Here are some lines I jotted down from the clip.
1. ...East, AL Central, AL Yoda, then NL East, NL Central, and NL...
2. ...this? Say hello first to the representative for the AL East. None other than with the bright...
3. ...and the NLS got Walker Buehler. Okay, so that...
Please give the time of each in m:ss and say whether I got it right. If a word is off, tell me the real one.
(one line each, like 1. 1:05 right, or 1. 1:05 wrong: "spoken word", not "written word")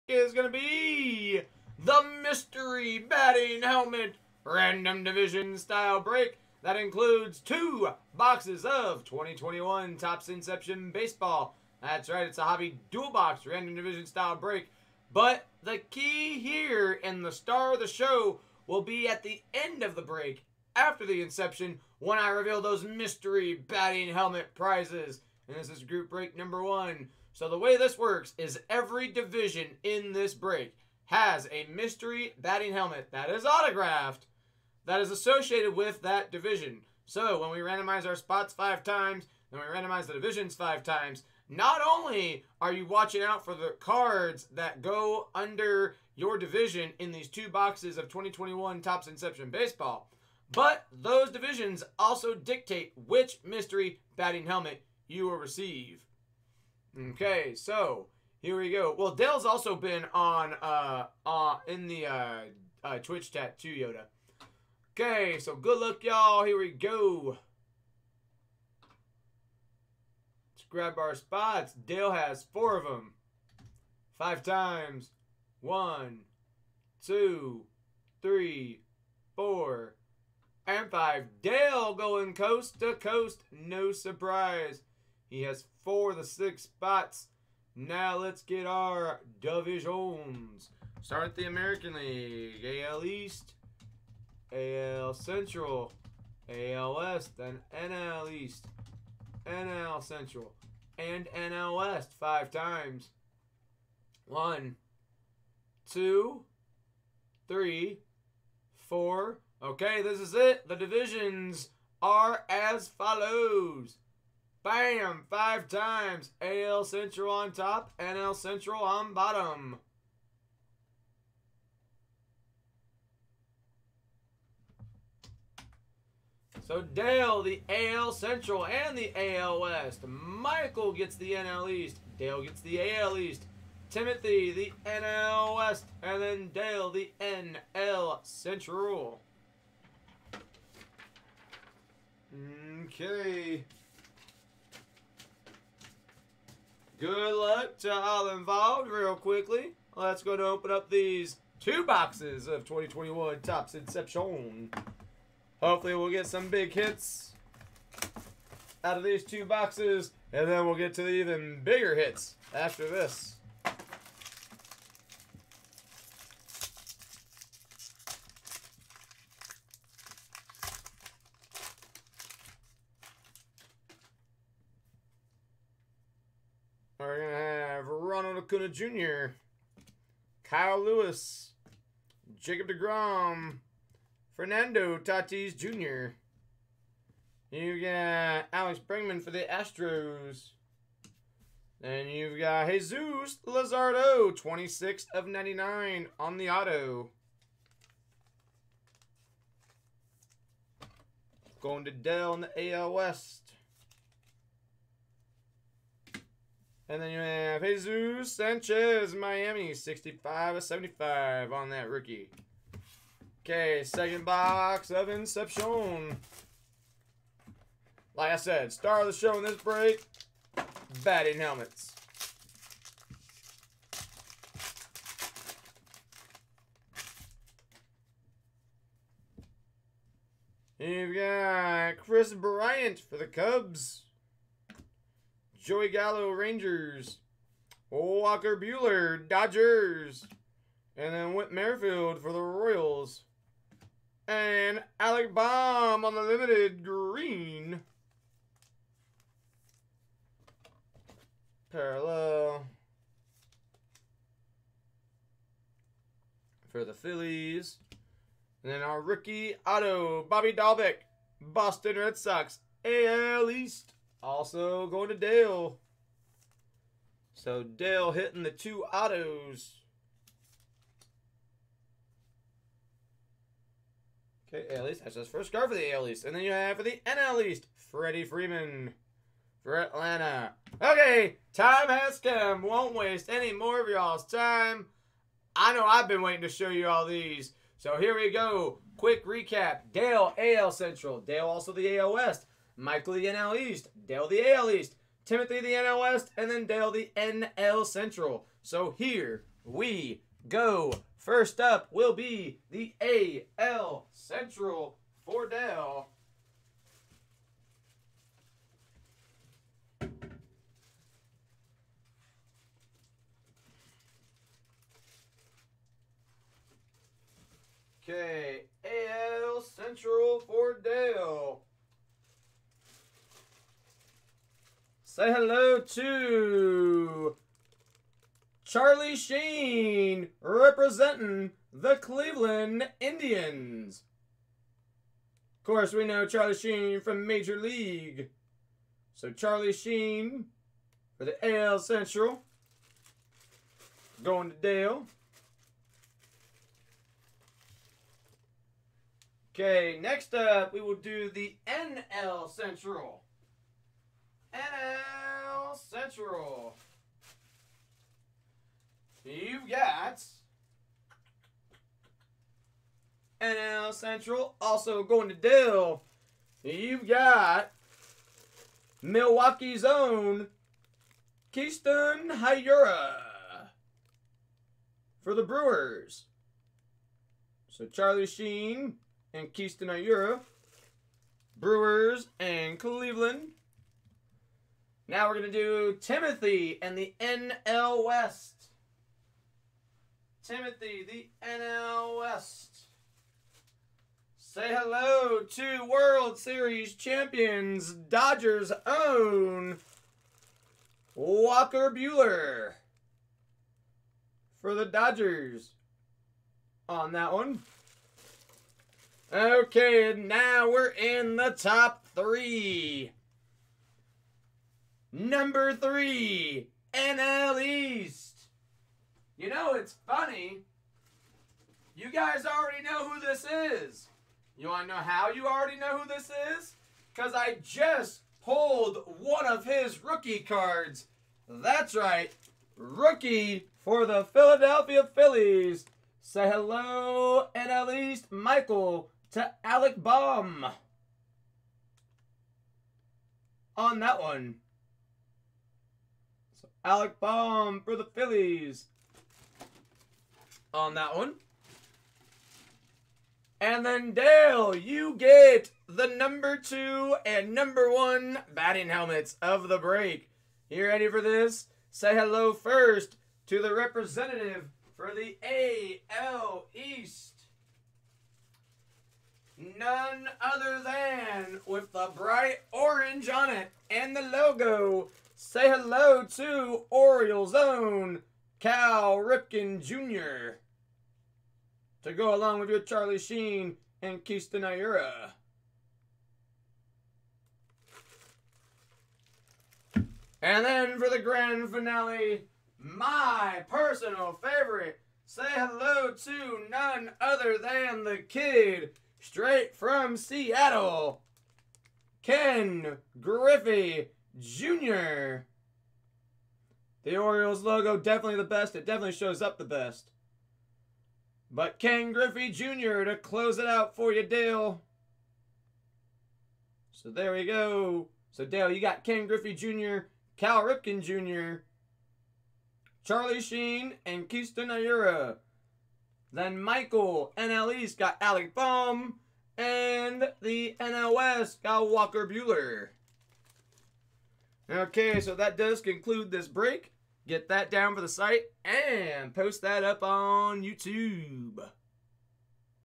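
1. 1:33 wrong: "West", not "Yoda"
2. 7:41 right
3. 8:49 right.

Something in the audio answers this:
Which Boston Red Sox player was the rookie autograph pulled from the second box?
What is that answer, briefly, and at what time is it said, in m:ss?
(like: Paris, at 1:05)
Bobby Dalbec, at 4:20.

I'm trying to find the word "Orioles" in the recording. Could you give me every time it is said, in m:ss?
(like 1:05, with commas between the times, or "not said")
7:56, 8:27.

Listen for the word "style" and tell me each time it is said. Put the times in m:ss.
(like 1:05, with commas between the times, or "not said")
0:05, 0:14.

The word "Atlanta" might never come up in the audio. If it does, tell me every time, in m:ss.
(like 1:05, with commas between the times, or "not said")
4:39.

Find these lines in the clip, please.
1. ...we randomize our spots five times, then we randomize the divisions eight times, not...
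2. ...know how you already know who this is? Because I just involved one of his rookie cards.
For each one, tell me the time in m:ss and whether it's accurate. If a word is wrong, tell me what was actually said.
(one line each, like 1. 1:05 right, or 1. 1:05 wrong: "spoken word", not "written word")
1. 0:37 wrong: "five", not "eight"
2. 7:04 wrong: "pulled", not "involved".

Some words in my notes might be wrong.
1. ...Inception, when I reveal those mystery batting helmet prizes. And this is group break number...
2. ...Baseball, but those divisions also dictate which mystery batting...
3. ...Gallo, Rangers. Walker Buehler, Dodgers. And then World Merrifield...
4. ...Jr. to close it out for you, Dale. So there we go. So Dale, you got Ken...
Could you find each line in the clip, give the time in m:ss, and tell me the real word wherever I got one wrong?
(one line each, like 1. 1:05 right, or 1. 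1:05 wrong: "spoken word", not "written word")
1. 0:21 right
2. 0:49 right
3. 3:55 wrong: "Whit", not "World"
4. 8:32 right.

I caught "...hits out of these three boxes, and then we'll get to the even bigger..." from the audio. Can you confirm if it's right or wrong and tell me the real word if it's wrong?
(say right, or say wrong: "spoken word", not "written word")
wrong: "two", not "three".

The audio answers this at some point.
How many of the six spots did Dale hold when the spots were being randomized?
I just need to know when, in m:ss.
1:25.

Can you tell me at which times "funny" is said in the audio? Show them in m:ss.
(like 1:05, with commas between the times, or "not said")
7:00.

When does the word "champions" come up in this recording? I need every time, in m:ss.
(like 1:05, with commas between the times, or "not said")
6:36.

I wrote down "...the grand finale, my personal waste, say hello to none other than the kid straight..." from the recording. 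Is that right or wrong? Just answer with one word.
wrong.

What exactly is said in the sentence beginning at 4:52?
Michael the NL East, Dale the AL East, Timothy the NL West, and then Dale the NL Central.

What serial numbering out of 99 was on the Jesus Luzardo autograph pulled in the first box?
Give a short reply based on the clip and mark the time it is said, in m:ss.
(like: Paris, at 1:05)
26 of 99, at 3:14.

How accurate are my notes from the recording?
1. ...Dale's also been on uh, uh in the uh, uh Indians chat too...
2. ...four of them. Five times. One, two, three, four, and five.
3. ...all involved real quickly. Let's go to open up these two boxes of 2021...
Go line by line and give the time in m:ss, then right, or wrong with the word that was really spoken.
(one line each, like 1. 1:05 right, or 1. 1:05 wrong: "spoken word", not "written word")
1. 0:59 wrong: "Twitch", not "Indians"
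2. 1:12 right
3. 2:27 right.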